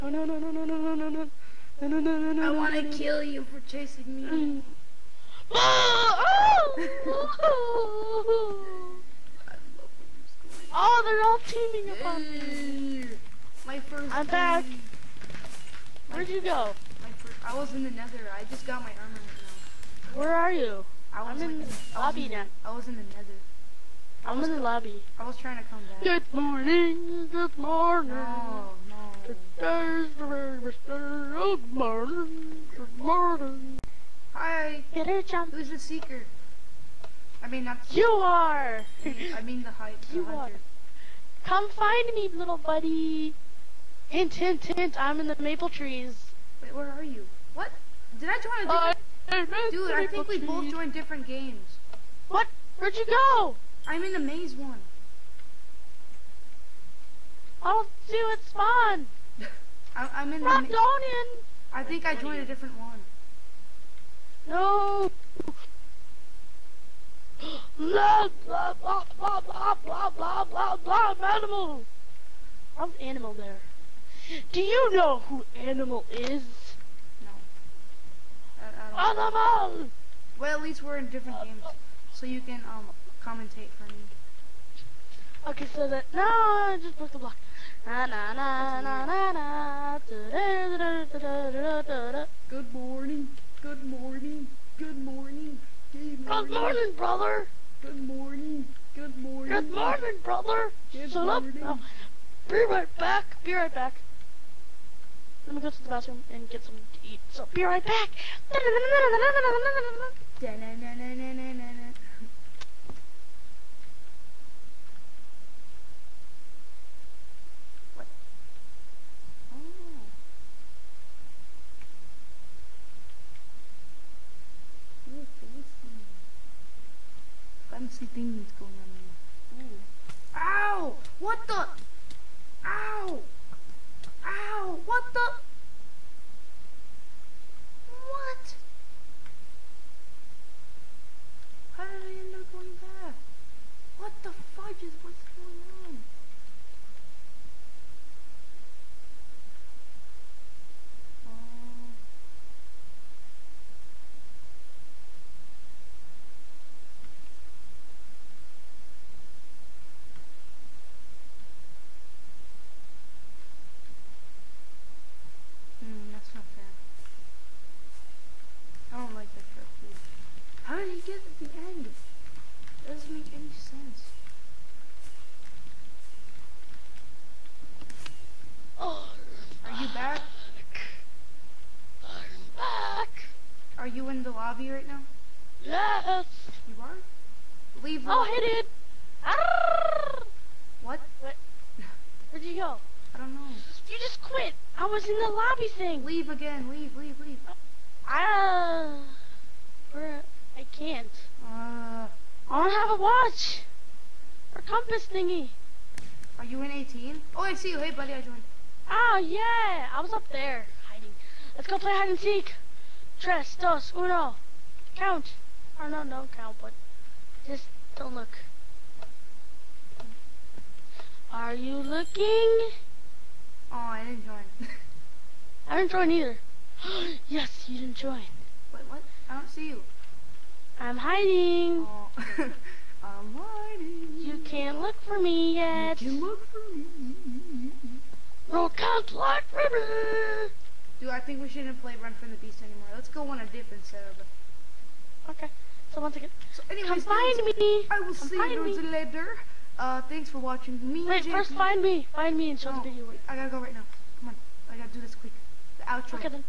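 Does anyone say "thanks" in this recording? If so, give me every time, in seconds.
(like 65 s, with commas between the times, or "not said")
250 s.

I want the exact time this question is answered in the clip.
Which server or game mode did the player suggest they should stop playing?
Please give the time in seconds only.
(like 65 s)
242 s.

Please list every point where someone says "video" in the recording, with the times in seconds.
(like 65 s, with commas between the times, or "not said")
252 s.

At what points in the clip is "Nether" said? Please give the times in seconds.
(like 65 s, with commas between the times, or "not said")
17 s, 23 s.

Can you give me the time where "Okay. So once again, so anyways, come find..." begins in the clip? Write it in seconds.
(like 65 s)
245 s.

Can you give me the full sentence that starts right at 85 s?
Okay, so that no, I just broke the block.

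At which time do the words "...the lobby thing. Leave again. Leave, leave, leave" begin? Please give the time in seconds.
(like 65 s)
195 s.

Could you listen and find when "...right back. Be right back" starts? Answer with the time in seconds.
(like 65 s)
102 s.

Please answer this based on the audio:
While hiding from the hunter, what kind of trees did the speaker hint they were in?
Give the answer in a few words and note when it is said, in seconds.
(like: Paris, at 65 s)
Maple trees, at 45 s.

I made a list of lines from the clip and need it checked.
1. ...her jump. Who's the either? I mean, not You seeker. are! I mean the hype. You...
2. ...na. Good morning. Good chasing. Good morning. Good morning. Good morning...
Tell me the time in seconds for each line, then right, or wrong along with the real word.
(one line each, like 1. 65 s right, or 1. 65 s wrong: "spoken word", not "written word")
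1. 35 s wrong: "seeker", not "either"
2. 90 s wrong: "morning", not "chasing".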